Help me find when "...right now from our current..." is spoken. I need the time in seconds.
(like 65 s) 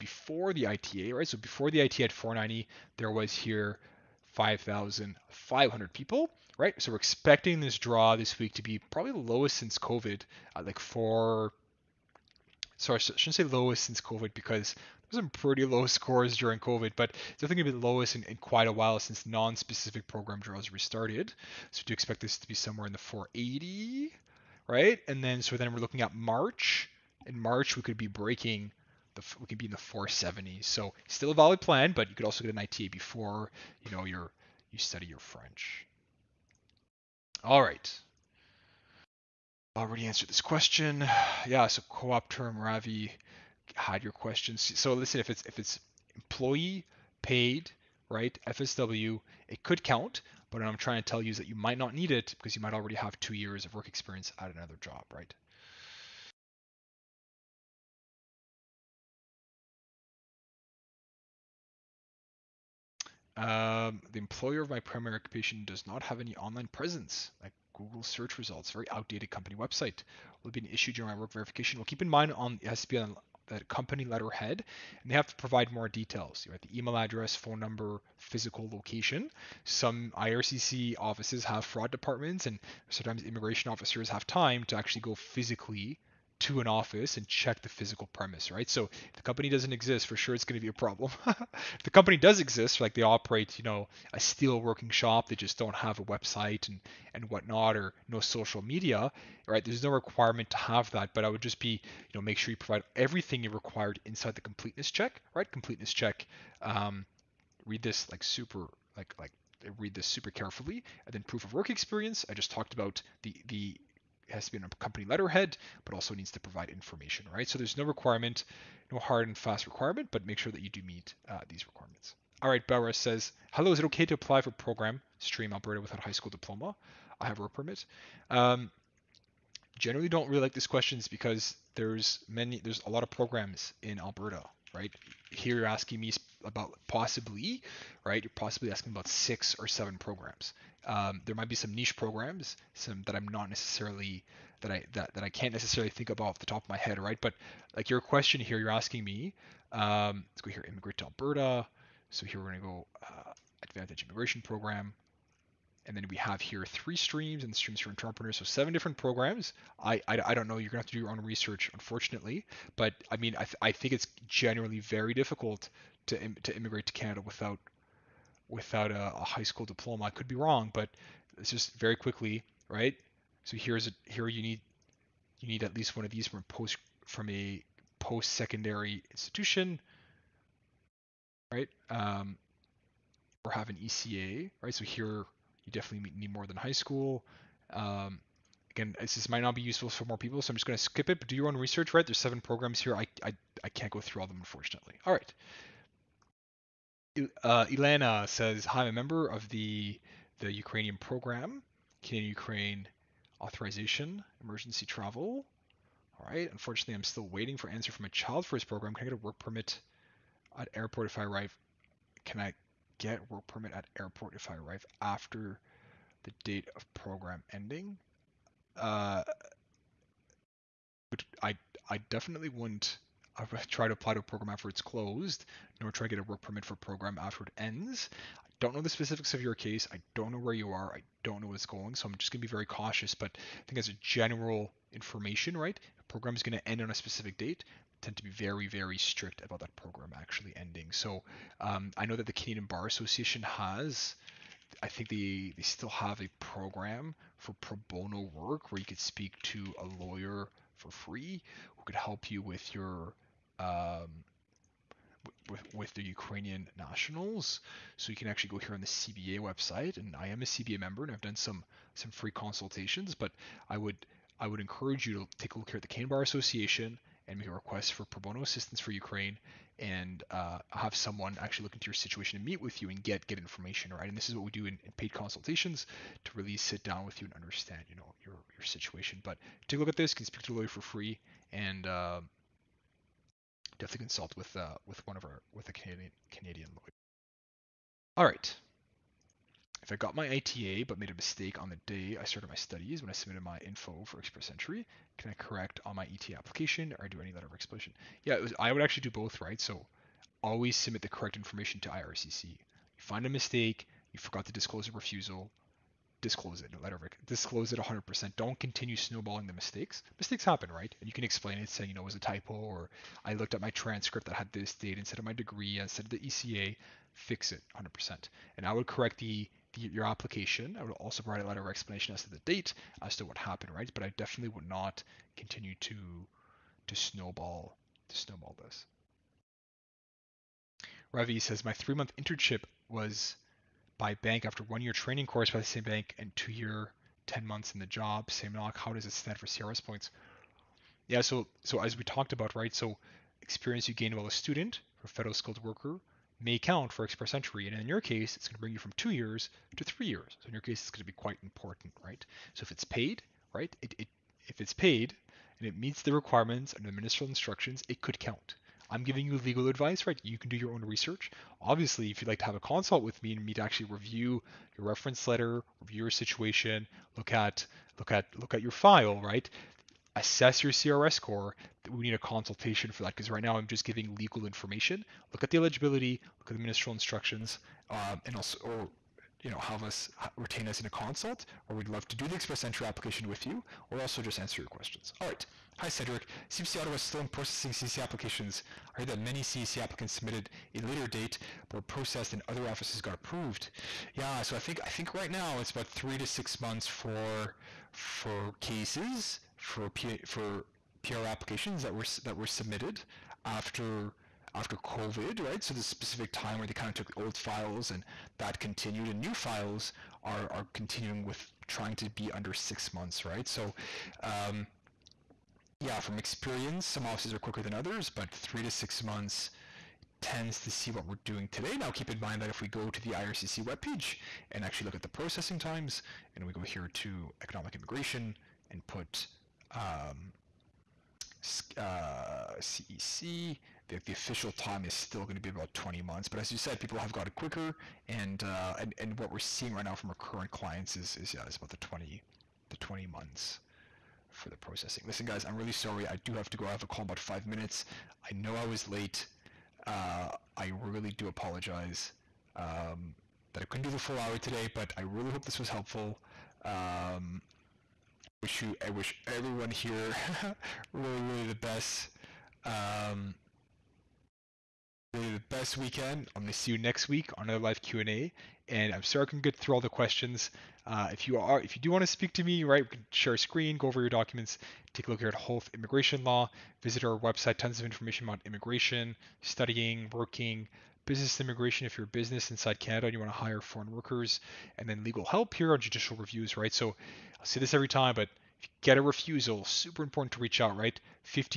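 439 s.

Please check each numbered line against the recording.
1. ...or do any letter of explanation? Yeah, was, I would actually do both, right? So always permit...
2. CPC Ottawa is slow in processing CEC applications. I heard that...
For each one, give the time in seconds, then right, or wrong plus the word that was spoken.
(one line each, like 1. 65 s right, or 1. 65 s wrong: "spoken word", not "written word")
1. 296 s wrong: "submit", not "permit"
2. 386 s right.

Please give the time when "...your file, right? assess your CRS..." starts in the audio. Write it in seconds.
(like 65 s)
368 s.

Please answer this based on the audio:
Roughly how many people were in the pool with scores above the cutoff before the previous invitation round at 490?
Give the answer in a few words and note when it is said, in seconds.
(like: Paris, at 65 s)
5,500, at 4 s.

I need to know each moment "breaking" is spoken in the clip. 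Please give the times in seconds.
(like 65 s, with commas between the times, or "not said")
28 s.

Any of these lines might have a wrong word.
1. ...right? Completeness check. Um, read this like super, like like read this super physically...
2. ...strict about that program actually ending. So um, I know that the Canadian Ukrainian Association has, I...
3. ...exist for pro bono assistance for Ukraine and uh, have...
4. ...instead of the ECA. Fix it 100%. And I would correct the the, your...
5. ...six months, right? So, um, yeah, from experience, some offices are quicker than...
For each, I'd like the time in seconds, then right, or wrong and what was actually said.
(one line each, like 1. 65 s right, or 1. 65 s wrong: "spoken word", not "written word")
1. 105 s wrong: "carefully", not "physically"
2. 238 s wrong: "Bar", not "Ukrainian"
3. 267 s wrong: "request", not "exist"
4. 315 s right
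5. 412 s right.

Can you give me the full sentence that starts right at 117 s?
So there's no requirement, no hard and fast requirement, but make sure that you do meet uh, these requirements.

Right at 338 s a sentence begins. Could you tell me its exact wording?
How does it stand for CRS points?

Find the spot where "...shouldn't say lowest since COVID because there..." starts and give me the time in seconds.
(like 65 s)
12 s.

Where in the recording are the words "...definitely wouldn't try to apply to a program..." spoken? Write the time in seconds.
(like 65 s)
222 s.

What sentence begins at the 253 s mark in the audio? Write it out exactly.
Um, with, with the Ukrainian nationals.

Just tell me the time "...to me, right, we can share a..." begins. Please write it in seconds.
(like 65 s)
472 s.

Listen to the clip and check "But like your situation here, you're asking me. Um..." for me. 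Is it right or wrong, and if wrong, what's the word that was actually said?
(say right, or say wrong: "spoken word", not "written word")
wrong: "question", not "situation".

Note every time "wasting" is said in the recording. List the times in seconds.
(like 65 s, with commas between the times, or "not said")
not said.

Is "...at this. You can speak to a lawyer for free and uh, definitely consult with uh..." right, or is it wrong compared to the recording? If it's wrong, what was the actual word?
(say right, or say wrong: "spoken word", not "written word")
right.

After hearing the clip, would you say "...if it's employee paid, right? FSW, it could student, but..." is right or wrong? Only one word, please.
wrong.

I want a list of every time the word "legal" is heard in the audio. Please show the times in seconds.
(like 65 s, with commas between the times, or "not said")
359 s, 374 s, 485 s.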